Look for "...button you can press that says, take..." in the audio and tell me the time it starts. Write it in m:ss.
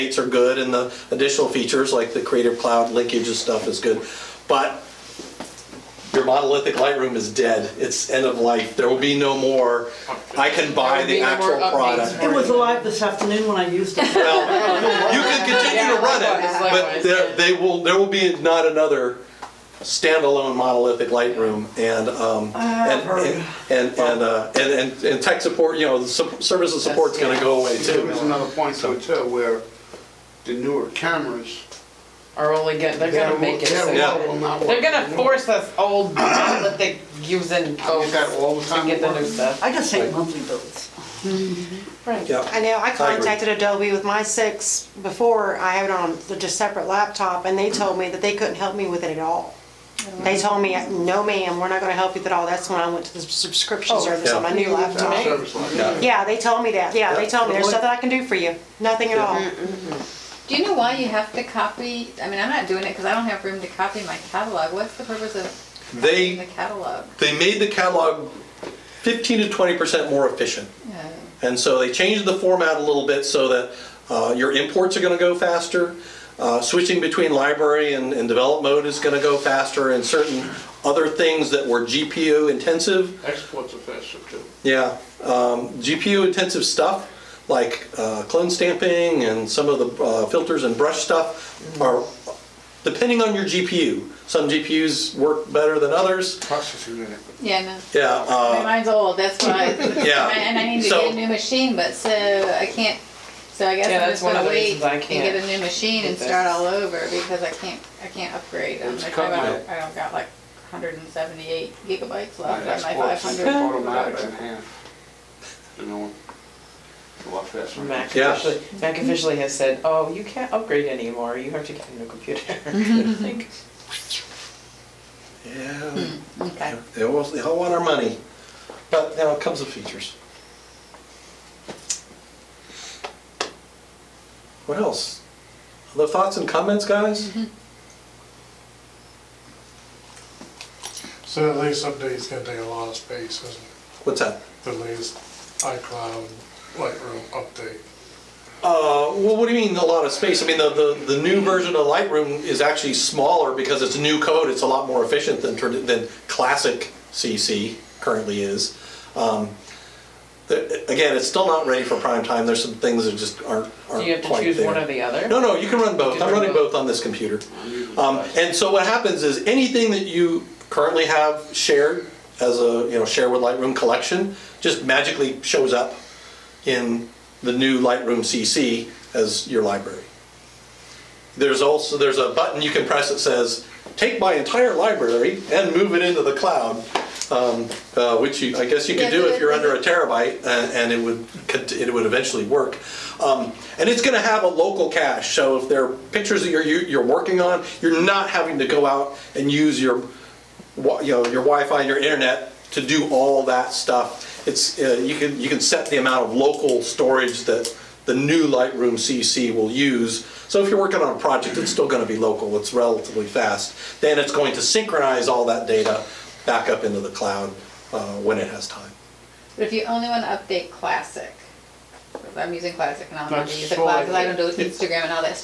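3:02.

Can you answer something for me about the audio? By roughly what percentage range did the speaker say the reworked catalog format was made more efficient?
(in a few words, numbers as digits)
15 to 20 percent.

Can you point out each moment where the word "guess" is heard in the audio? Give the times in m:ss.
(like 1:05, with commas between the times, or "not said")
1:43, 3:08.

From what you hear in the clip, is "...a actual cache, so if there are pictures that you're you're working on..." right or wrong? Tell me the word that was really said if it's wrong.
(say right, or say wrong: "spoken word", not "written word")
wrong: "local", not "actual".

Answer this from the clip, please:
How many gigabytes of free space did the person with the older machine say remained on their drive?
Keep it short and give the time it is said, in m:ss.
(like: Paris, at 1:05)
178, at 1:50.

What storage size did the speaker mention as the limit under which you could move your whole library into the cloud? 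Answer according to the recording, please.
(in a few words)
a terabyte.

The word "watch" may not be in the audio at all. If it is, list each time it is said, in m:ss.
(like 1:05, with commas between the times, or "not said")
1:57.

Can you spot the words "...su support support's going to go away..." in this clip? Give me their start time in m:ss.
0:26.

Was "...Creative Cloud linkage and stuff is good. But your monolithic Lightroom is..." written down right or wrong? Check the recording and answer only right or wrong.
right.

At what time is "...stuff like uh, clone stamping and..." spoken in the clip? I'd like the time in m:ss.
1:26.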